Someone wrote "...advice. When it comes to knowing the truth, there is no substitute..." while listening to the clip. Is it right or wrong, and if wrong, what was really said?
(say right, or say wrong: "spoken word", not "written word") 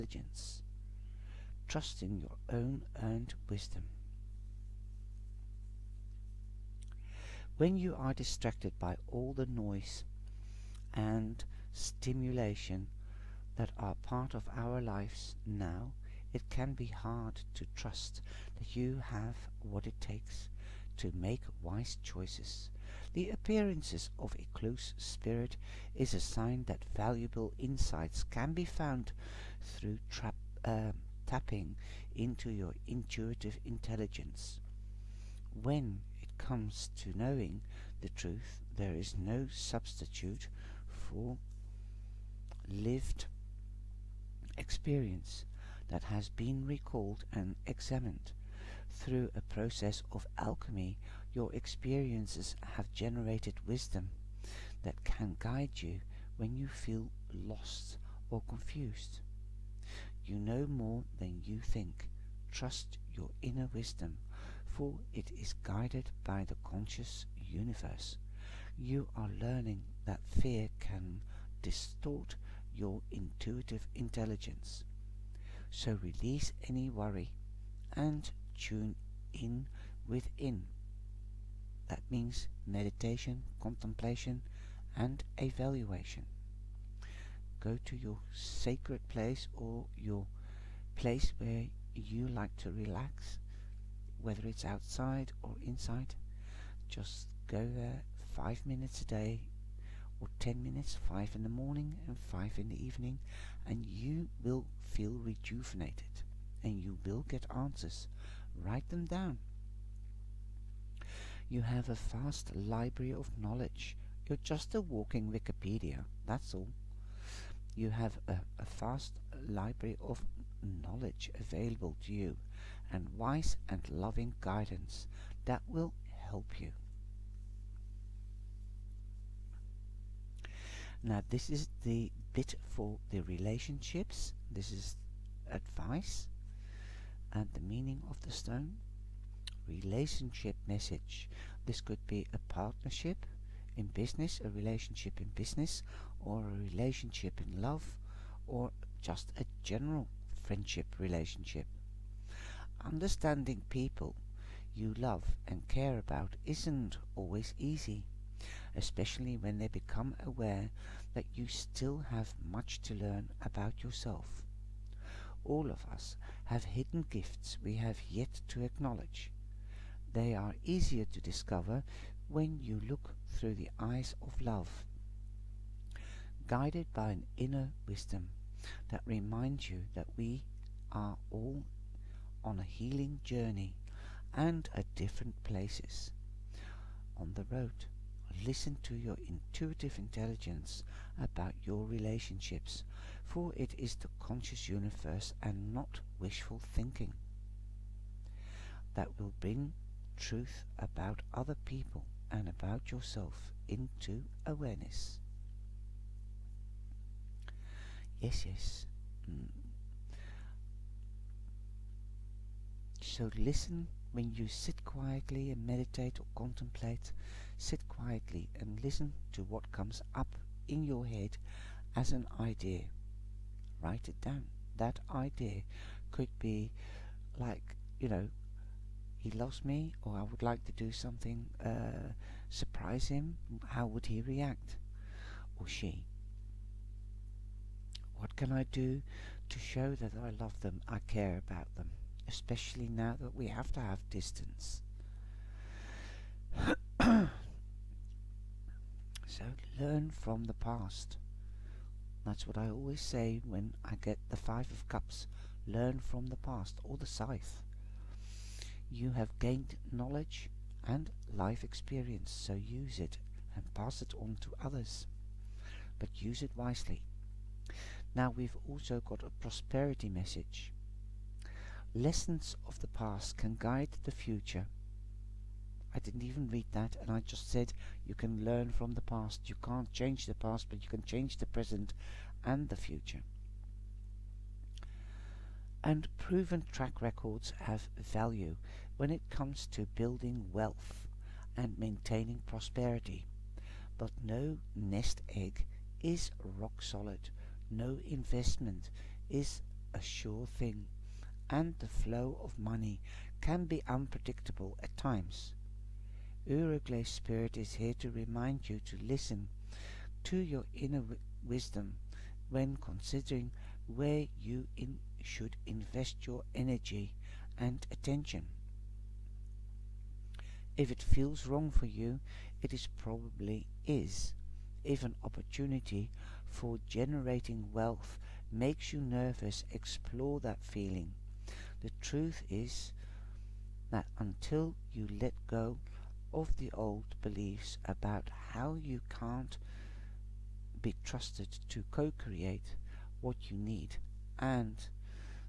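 wrong: "intelligence", not "advice".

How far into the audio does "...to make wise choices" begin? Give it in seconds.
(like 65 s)
20 s.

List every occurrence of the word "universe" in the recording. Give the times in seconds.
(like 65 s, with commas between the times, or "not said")
67 s, 194 s.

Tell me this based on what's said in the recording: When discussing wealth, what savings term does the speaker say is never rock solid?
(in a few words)
nest egg.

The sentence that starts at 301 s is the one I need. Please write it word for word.
And the flow of money can be unpredictable at times.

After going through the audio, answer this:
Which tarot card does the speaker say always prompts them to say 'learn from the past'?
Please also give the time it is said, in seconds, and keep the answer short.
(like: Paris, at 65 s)
Five of Cups, at 254 s.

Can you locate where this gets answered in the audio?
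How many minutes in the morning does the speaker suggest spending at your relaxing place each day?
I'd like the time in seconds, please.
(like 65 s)
101 s.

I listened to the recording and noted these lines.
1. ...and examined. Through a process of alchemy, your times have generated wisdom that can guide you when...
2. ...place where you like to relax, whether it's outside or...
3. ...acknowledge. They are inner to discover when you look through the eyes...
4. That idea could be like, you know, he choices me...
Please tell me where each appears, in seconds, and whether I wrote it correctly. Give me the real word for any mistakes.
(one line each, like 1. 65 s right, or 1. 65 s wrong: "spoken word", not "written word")
1. 47 s wrong: "experiences", not "times"
2. 90 s right
3. 168 s wrong: "easier", not "inner"
4. 224 s wrong: "loves", not "choices".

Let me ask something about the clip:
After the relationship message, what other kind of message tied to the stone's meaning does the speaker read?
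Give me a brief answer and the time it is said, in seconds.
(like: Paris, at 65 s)
prosperity message, at 269 s.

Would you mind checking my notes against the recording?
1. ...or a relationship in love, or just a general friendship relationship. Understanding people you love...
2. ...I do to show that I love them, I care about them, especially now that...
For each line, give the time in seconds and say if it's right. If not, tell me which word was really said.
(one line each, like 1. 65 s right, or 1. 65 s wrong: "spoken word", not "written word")
1. 146 s right
2. 238 s right.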